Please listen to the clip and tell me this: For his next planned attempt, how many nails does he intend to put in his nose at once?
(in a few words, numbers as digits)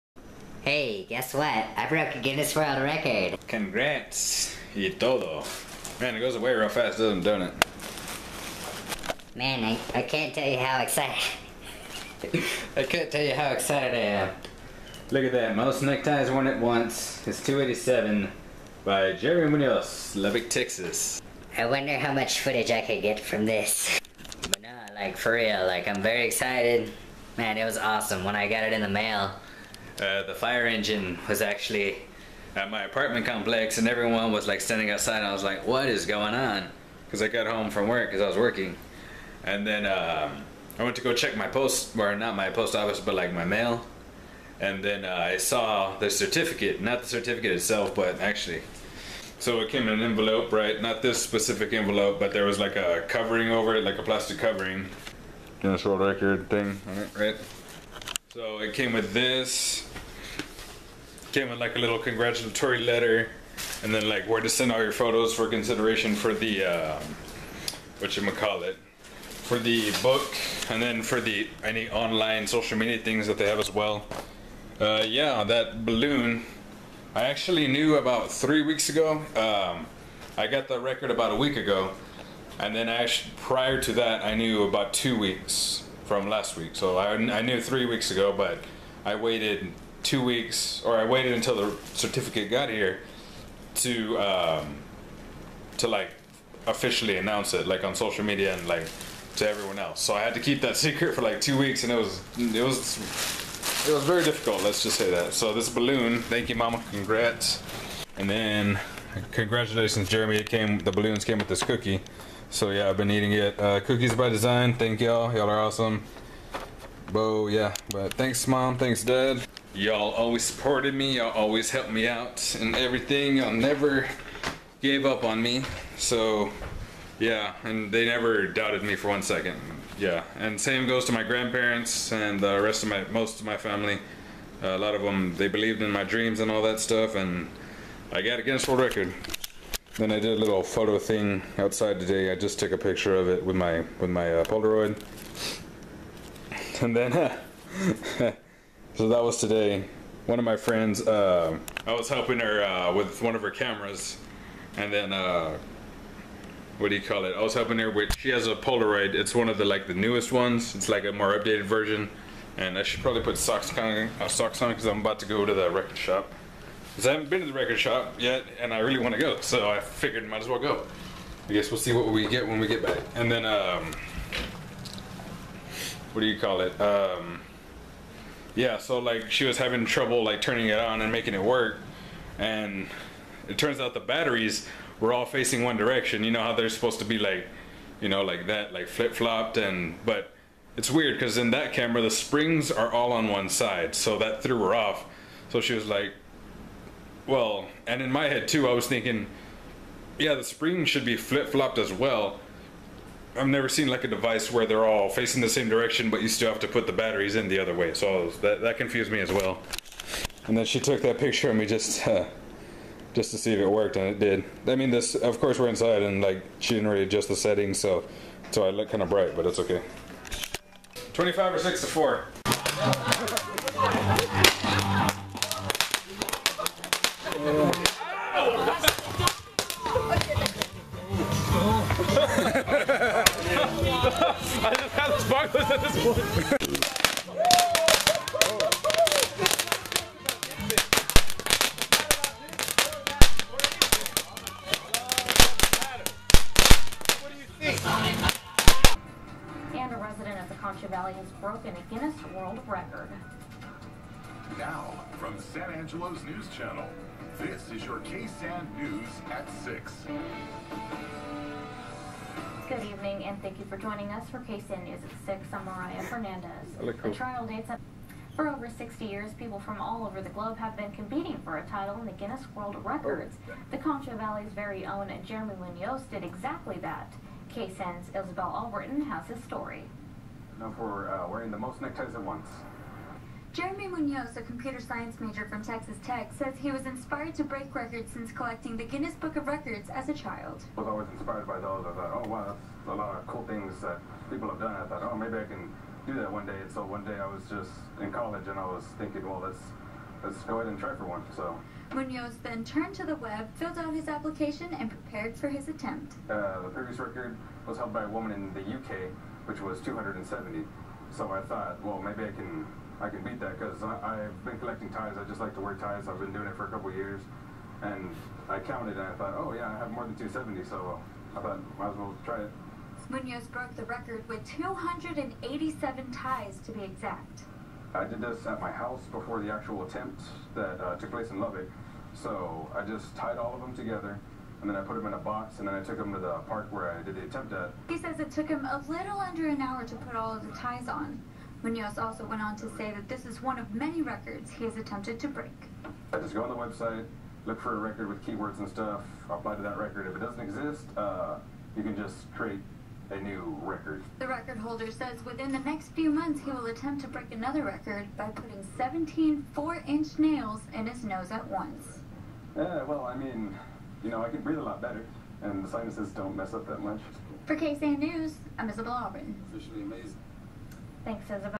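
17.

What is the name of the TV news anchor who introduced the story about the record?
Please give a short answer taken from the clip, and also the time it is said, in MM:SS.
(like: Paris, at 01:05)
Mariah Fernandez, at 04:25.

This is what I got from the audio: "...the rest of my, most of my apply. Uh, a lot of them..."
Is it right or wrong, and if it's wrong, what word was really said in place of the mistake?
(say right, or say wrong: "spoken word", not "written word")
wrong: "family", not "apply".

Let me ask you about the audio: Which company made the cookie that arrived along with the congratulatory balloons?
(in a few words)
Cookies by Design.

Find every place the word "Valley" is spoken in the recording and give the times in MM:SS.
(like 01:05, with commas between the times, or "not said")
04:10, 04:34.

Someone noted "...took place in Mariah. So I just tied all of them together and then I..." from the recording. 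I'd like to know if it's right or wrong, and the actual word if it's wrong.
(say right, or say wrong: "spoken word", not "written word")
wrong: "Lubbock", not "Mariah".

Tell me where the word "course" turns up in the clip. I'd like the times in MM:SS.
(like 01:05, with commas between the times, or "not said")
03:35.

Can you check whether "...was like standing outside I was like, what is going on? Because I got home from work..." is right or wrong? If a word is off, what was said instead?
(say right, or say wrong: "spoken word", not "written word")
right.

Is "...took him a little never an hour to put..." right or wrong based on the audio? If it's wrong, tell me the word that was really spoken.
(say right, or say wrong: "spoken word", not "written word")
wrong: "under", not "never".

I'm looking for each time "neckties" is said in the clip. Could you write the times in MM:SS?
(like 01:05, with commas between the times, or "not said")
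00:15, 04:41.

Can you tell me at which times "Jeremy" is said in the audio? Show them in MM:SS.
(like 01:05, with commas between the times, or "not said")
01:50, 04:35, 04:43.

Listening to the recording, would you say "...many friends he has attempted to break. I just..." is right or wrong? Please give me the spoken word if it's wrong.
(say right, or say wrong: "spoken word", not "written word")
wrong: "records", not "friends".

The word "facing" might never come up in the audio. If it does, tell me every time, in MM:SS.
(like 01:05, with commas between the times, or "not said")
03:05, 03:25.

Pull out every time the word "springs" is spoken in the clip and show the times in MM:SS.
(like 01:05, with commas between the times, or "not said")
03:12, 03:20.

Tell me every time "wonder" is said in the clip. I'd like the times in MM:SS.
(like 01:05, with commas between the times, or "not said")
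00:21.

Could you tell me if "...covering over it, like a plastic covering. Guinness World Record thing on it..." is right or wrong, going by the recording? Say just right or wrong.
right.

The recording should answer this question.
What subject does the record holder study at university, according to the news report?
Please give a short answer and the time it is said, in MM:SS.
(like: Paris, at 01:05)
Computer science, at 04:44.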